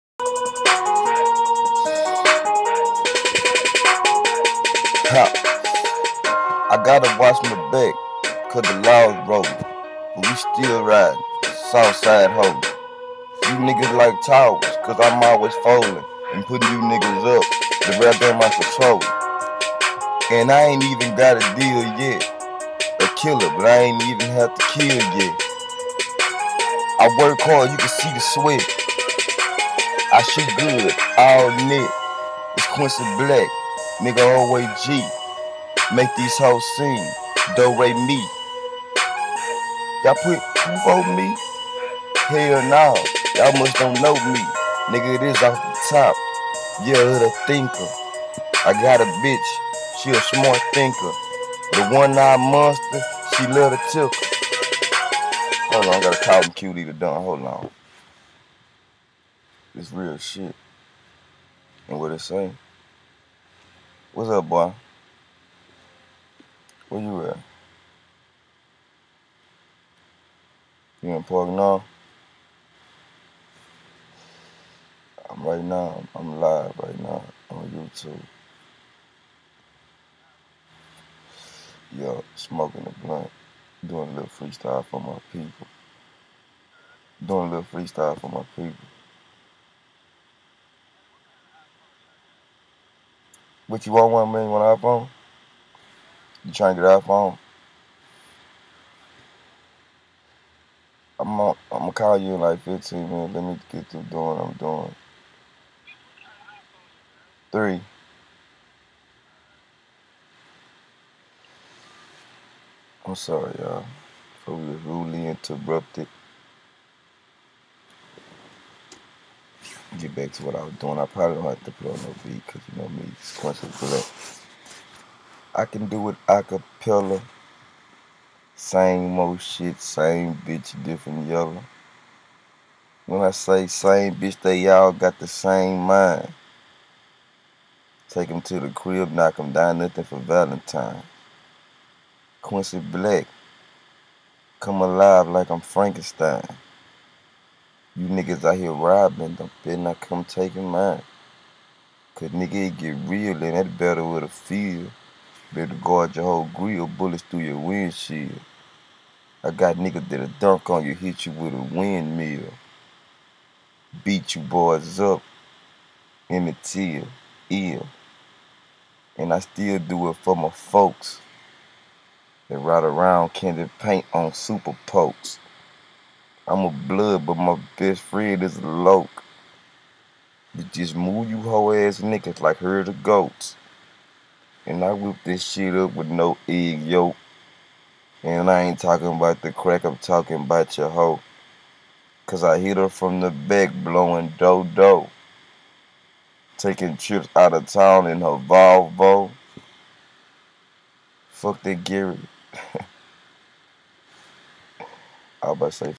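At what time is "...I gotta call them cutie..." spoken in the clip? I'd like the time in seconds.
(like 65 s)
55 s.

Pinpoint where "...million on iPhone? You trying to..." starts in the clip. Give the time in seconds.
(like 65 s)
94 s.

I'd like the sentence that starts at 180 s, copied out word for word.
You just move you hoe ass niggas like herd of goats.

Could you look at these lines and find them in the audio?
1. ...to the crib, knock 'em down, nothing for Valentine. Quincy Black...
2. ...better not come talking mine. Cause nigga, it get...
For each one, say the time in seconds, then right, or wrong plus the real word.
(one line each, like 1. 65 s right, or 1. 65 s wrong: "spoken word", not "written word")
1. 138 s right
2. 149 s wrong: "taking", not "talking".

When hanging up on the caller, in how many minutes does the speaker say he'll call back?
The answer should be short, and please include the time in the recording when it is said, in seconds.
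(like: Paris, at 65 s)
15, at 102 s.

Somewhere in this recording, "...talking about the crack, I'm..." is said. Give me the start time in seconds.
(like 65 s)
188 s.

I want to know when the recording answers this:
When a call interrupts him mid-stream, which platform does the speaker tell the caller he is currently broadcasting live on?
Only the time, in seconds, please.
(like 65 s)
77 s.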